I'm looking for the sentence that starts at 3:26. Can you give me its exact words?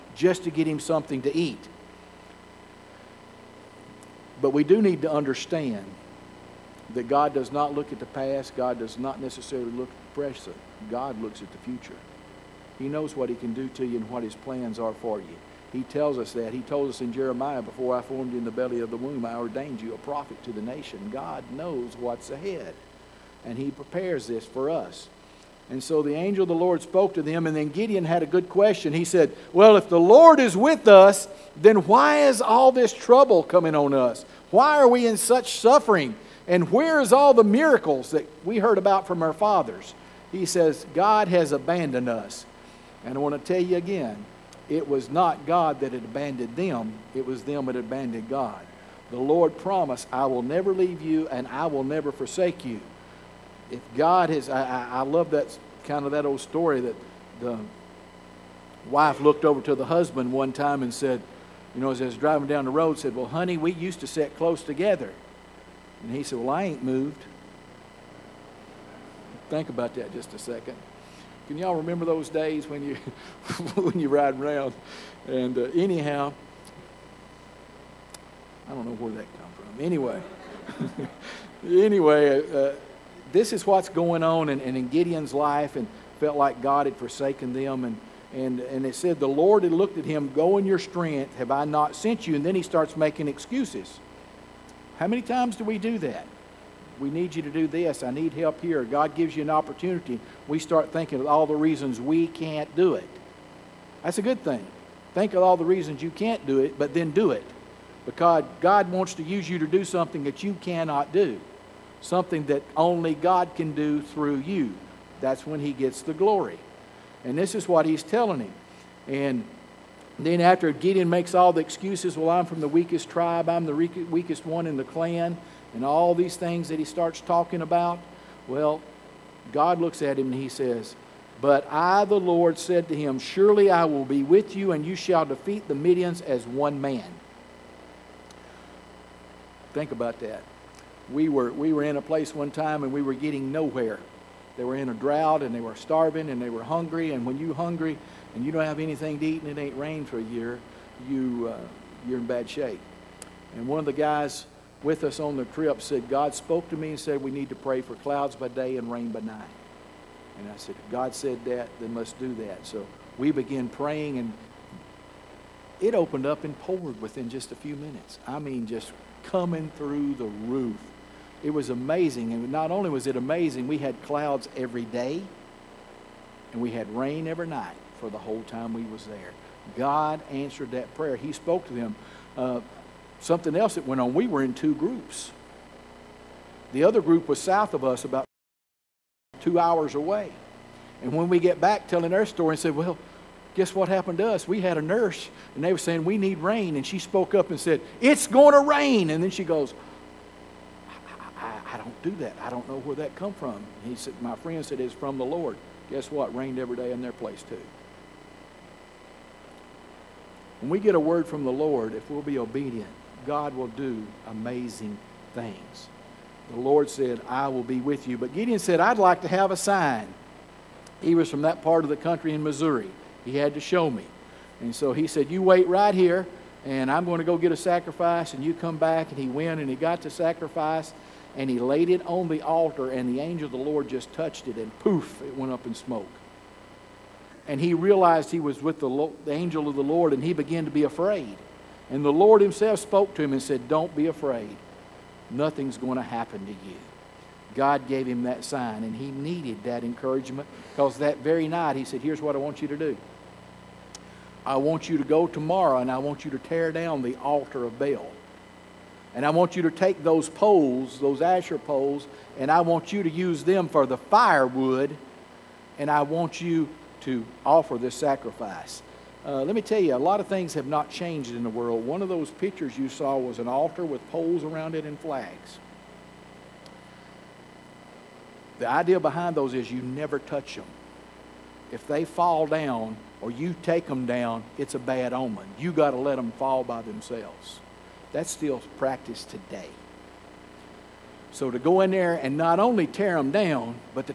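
Rained every day in their place too.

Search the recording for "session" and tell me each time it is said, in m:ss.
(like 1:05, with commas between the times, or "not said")
not said.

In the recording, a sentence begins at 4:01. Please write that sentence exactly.
And the Lord himself spoke to him and said, Don't be afraid.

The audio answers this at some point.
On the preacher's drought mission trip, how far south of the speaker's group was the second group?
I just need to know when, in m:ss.
3:09.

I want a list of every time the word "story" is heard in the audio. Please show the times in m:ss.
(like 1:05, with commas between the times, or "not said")
0:56, 3:12.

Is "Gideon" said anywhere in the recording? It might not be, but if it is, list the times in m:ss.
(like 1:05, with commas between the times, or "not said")
0:27, 1:24, 2:00, 3:38.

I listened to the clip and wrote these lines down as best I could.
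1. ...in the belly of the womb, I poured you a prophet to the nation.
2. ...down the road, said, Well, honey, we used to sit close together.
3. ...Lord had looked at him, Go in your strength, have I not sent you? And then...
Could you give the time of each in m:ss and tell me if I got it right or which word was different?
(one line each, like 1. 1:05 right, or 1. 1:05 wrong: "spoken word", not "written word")
1. 0:18 wrong: "ordained", not "poured"
2. 1:02 right
3. 1:29 right.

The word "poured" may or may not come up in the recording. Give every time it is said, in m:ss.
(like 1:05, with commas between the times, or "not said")
2:46.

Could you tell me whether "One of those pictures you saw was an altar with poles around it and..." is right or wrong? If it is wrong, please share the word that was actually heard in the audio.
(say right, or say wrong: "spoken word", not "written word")
right.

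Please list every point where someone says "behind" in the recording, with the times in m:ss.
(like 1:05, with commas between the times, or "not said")
4:38.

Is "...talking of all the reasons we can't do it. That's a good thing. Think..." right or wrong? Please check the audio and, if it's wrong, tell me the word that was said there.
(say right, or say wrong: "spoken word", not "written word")
wrong: "thinking", not "talking".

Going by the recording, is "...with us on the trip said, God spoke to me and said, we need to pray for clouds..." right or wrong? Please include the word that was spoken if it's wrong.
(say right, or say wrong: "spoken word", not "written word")
right.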